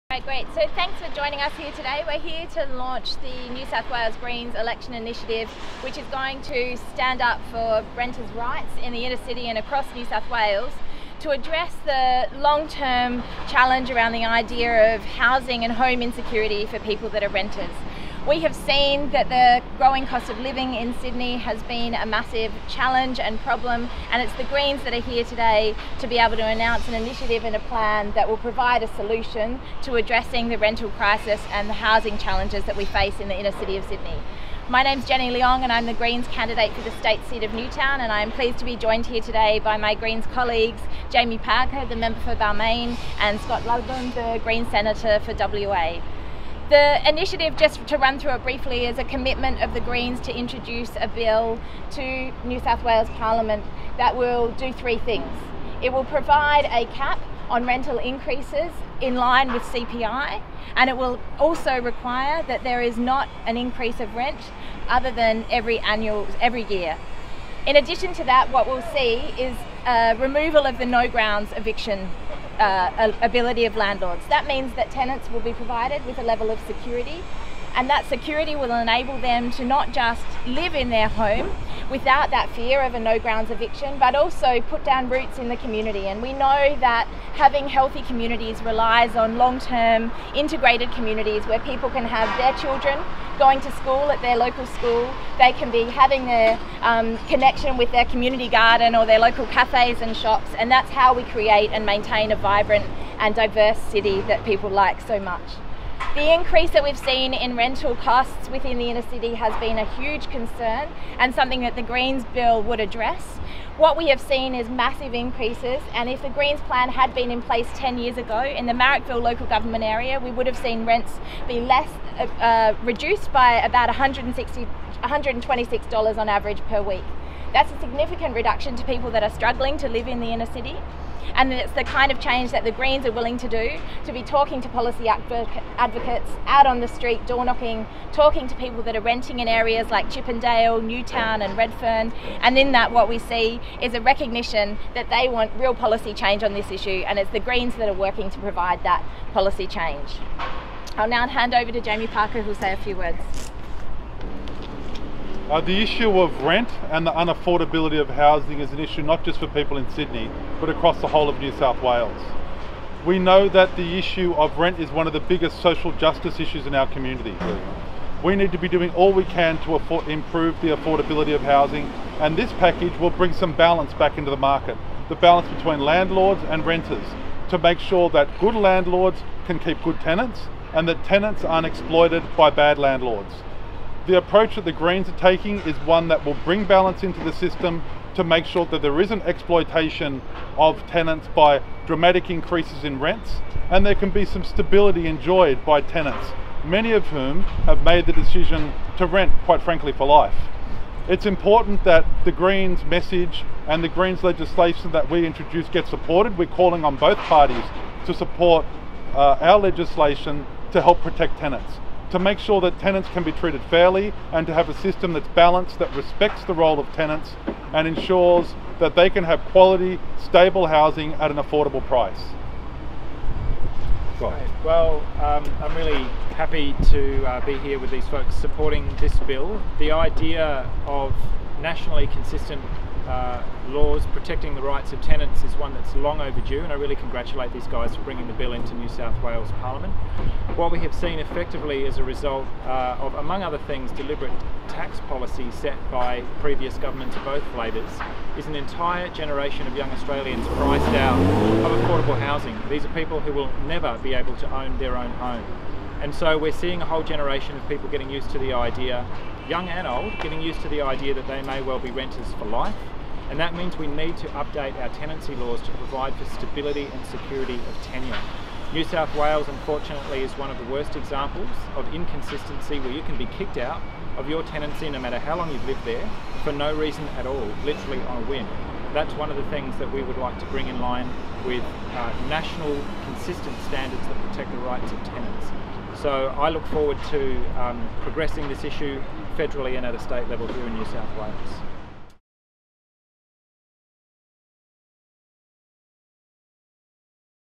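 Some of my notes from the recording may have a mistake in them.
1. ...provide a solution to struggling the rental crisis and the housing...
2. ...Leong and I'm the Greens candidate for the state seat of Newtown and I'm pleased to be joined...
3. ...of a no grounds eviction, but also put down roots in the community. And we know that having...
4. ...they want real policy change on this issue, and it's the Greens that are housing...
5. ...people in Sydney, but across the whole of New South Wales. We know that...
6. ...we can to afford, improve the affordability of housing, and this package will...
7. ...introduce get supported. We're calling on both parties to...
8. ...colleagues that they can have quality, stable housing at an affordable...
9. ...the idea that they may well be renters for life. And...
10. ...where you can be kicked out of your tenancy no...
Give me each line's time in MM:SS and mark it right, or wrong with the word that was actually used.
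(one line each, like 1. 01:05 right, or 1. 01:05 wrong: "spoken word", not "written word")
1. 00:28 wrong: "addressing", not "struggling"
2. 00:35 right
3. 01:22 right
4. 02:25 wrong: "working", not "housing"
5. 02:39 right
6. 02:49 right
7. 03:25 right
8. 03:37 wrong: "ensures", not "colleagues"
9. 04:20 right
10. 04:32 right.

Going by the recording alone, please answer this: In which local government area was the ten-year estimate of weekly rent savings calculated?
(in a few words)
Marrickville.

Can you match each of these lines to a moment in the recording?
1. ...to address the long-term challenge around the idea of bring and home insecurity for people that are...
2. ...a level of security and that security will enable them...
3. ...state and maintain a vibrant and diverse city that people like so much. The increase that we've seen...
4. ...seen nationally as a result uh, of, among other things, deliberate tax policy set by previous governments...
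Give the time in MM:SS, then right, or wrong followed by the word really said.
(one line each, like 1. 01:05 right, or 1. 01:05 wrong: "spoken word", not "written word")
1. 00:11 wrong: "housing", not "bring"
2. 01:16 right
3. 01:41 wrong: "create", not "state"
4. 04:00 wrong: "effectively", not "nationally".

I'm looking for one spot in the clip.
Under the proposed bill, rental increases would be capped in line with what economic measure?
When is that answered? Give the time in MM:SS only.
00:59.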